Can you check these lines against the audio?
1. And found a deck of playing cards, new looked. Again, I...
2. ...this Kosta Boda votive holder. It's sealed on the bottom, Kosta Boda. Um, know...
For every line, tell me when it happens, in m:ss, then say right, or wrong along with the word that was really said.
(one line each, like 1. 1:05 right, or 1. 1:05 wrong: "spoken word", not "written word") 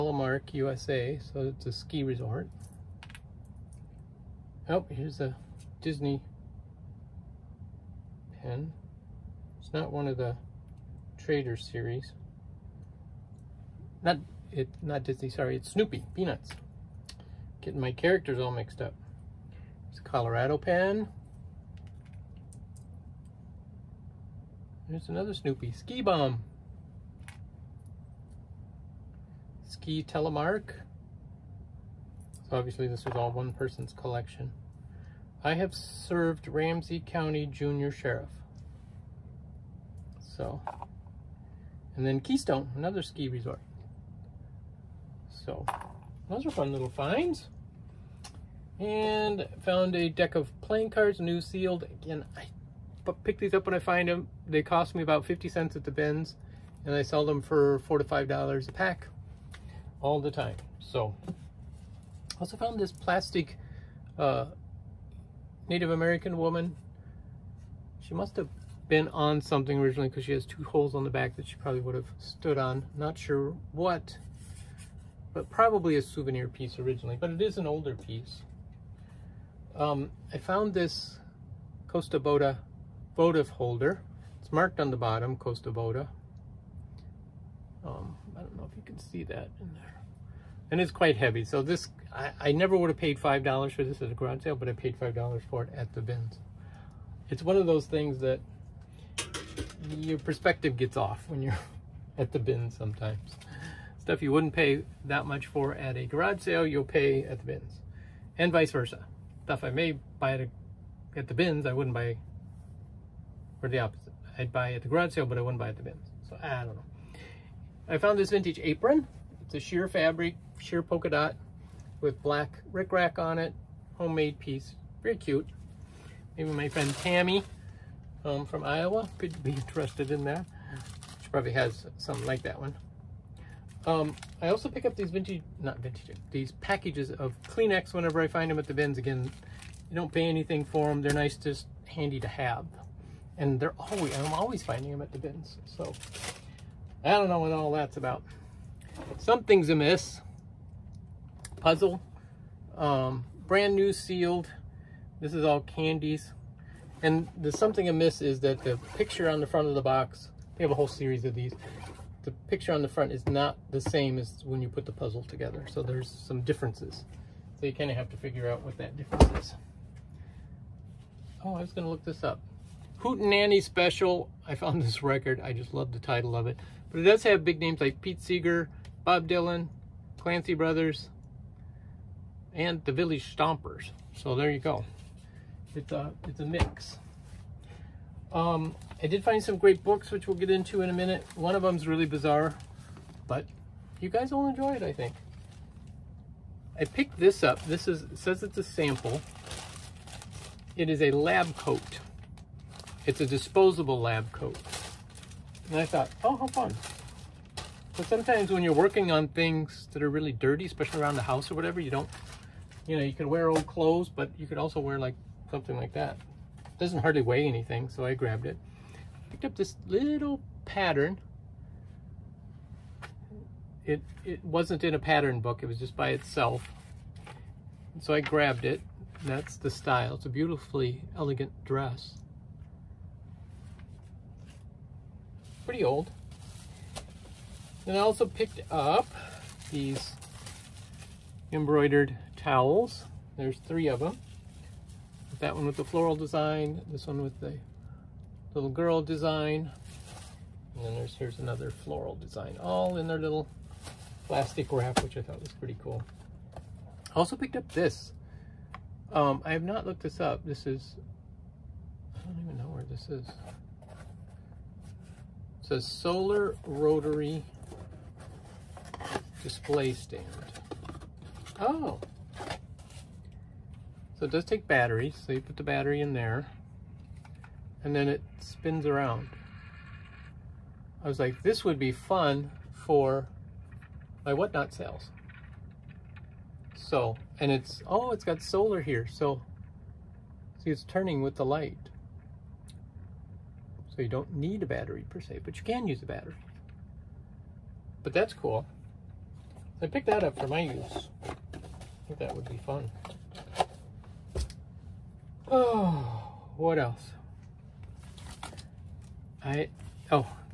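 1. 0:48 wrong: "sealed", not "looked"
2. 1:20 wrong: "marked", not "sealed".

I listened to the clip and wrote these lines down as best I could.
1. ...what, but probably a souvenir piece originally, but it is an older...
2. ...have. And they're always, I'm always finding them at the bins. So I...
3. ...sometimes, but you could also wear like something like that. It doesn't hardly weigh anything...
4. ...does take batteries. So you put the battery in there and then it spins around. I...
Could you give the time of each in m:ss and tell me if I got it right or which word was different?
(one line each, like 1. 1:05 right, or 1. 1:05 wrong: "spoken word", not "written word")
1. 1:13 right
2. 2:22 right
3. 3:33 wrong: "clothes", not "sometimes"
4. 4:34 right.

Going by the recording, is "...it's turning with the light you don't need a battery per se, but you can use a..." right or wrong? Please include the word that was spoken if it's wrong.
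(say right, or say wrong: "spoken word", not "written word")
right.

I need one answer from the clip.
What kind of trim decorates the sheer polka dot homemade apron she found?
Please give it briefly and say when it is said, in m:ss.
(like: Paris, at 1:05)
black rickrack, at 2:02.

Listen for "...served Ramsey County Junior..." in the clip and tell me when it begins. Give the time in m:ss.
0:35.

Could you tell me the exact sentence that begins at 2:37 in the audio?
And the something amiss is that the picture on the front of the box, they have a whole series of these.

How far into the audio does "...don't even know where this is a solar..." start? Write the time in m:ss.
4:22.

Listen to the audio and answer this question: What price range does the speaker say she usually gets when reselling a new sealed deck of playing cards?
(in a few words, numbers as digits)
$4 to $5.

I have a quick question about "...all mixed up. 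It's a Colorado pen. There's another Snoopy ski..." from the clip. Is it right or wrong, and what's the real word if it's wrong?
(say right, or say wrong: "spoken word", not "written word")
right.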